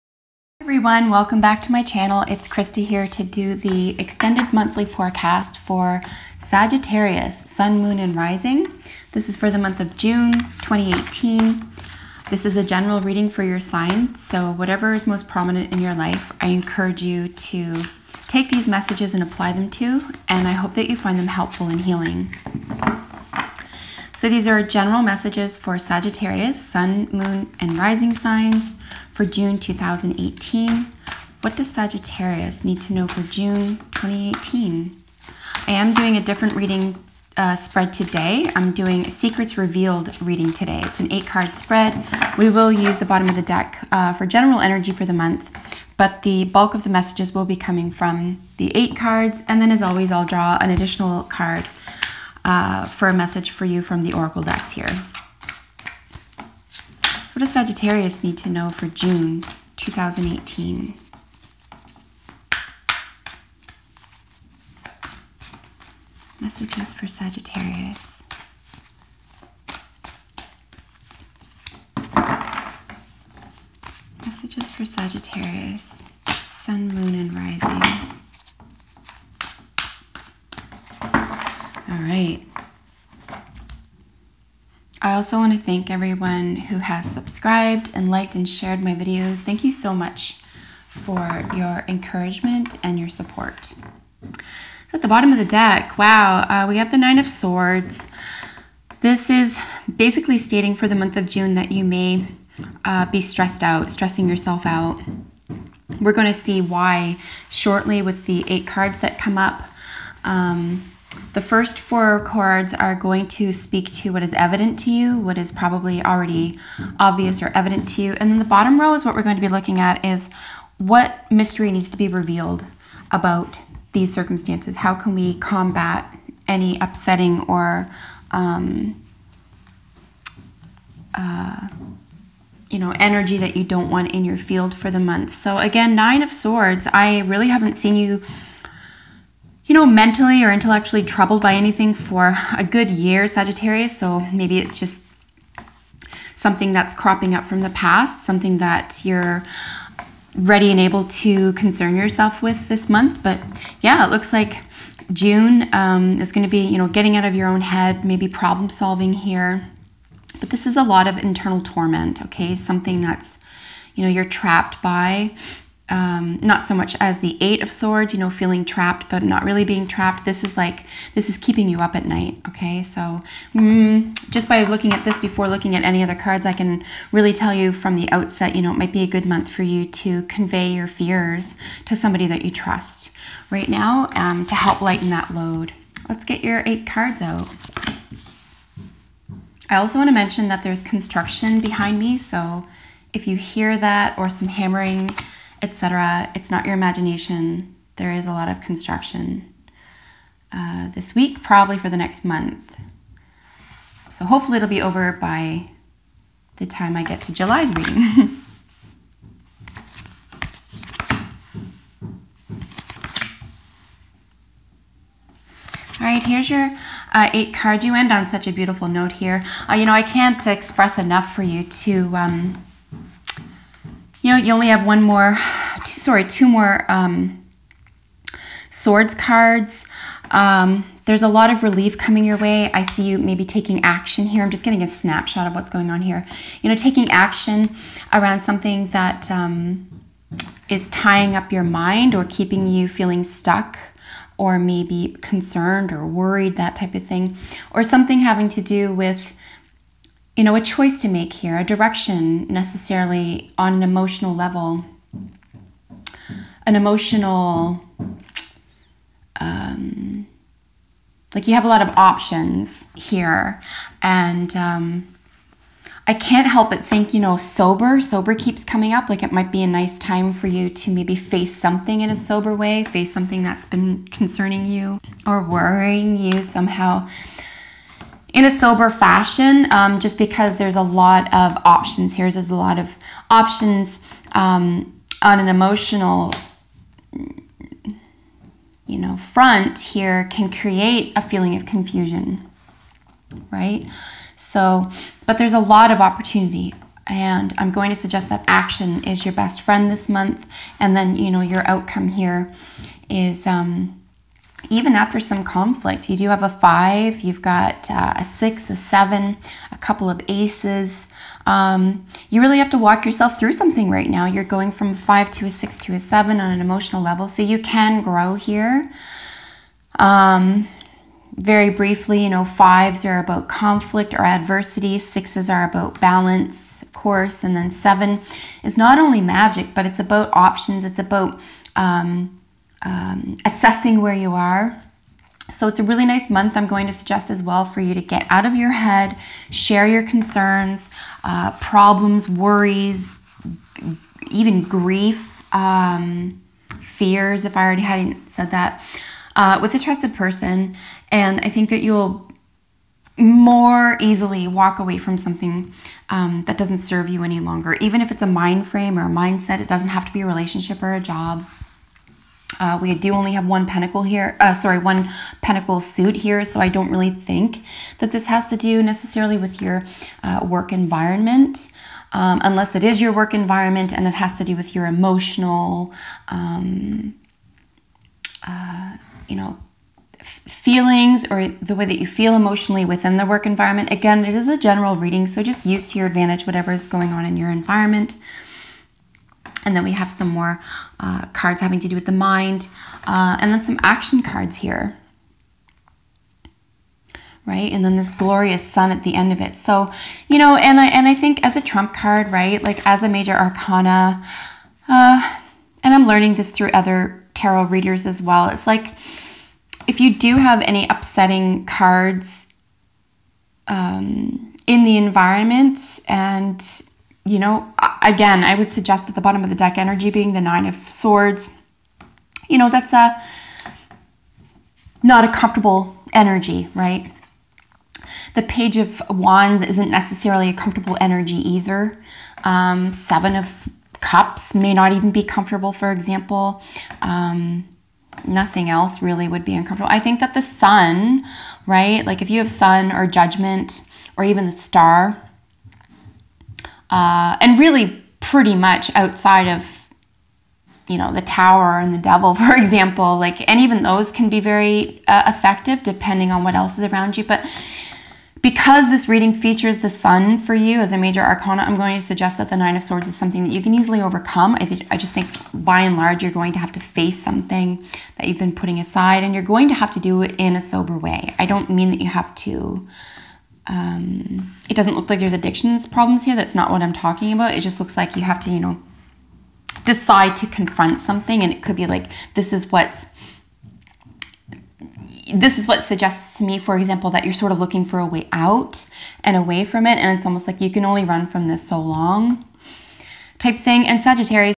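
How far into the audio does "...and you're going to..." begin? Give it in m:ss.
7:49.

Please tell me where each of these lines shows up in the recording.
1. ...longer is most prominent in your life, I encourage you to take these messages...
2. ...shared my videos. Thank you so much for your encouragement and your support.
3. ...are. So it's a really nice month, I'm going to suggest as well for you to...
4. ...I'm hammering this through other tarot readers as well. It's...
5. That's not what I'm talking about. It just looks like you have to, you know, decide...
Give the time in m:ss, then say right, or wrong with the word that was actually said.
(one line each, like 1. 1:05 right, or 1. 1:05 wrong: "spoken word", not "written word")
1. 0:14 wrong: "whatever", not "longer"
2. 1:28 right
3. 5:34 right
4. 6:45 wrong: "learning", not "hammering"
5. 7:56 right.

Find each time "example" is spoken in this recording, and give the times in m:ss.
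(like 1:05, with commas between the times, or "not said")
7:15, 7:32, 8:06.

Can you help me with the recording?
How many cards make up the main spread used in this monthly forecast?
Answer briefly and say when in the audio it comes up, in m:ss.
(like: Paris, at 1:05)
8, at 0:41.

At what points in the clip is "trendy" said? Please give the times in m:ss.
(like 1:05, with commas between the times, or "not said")
not said.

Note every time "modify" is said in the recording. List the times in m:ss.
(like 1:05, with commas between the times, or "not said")
not said.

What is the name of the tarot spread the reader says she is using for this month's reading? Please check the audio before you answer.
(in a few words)
Secrets Revealed.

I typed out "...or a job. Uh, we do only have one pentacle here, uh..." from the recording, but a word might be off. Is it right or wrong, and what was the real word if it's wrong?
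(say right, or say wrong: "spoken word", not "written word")
right.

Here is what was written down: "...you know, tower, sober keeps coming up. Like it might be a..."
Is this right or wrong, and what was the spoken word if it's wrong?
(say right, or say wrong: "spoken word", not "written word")
wrong: "sober", not "tower".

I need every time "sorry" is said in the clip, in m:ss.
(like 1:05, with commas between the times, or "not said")
3:45, 6:04.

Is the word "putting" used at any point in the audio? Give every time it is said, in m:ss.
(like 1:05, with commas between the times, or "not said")
7:48.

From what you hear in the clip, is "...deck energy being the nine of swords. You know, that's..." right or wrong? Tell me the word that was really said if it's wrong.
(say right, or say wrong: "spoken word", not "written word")
right.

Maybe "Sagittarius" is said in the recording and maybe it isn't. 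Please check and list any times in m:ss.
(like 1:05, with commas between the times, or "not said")
0:06, 0:25, 0:31, 0:57, 1:07, 1:14, 2:23, 8:14.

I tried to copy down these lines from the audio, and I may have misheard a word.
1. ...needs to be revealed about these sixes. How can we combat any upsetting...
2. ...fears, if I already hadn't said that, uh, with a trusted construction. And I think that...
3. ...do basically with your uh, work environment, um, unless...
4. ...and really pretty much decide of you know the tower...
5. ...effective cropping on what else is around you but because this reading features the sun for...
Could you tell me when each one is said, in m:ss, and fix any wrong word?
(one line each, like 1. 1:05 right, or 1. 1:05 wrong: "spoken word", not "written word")
1. 2:01 wrong: "circumstances", not "sixes"
2. 5:46 wrong: "person", not "construction"
3. 6:08 wrong: "necessarily", not "basically"
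4. 7:27 wrong: "outside", not "decide"
5. 7:35 wrong: "depending", not "cropping".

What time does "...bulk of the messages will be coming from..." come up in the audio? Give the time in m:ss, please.
0:46.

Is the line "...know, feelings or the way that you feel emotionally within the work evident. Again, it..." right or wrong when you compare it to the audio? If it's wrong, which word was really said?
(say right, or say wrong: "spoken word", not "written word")
wrong: "environment", not "evident".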